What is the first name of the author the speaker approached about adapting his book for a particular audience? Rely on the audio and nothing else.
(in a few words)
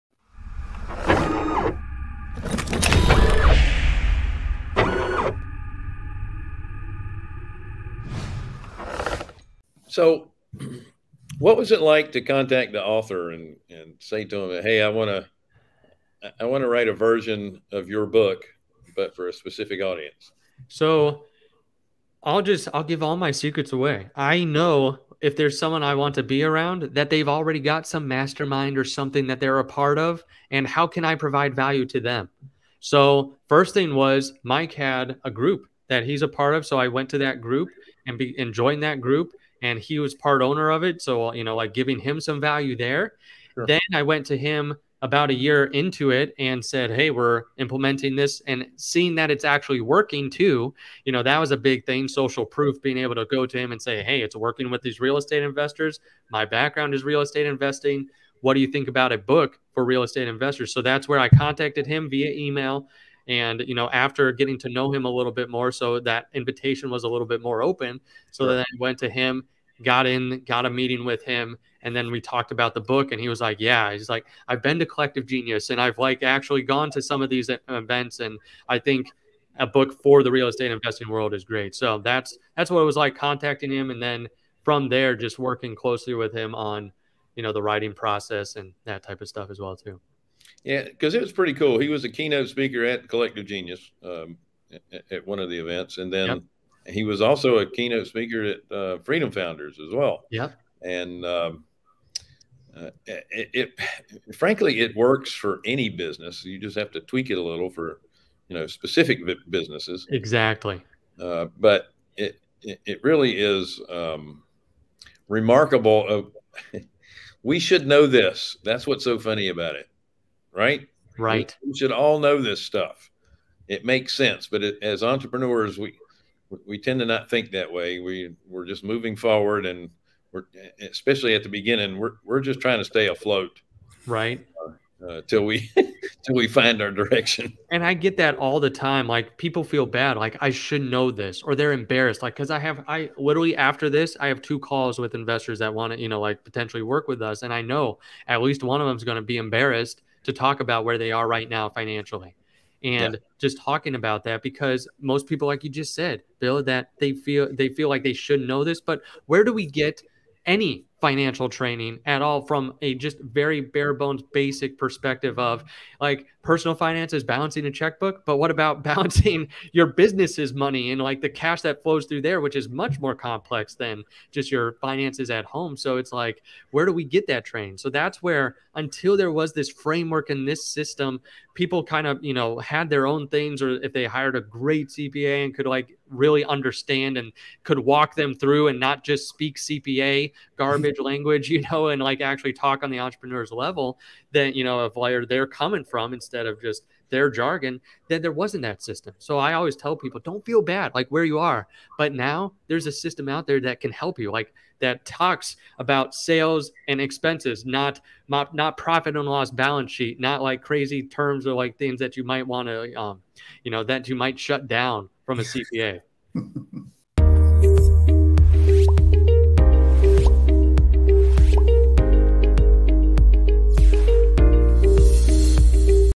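Mike.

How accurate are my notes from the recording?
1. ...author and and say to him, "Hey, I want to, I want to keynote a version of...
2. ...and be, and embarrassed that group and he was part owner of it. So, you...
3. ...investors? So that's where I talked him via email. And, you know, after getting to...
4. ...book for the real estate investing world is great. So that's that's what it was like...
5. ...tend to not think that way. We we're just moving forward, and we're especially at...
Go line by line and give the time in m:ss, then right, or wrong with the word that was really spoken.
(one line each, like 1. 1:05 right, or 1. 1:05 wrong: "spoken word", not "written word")
1. 0:12 wrong: "write", not "keynote"
2. 0:38 wrong: "joined", not "embarrassed"
3. 1:00 wrong: "contacted", not "talked"
4. 1:19 right
5. 2:06 right.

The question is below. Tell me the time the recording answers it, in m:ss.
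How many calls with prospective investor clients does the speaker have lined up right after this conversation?
2:24.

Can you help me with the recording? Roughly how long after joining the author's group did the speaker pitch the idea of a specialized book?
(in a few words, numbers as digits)
a year.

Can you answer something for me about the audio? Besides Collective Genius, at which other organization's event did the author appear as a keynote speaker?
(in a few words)
Freedom Founders.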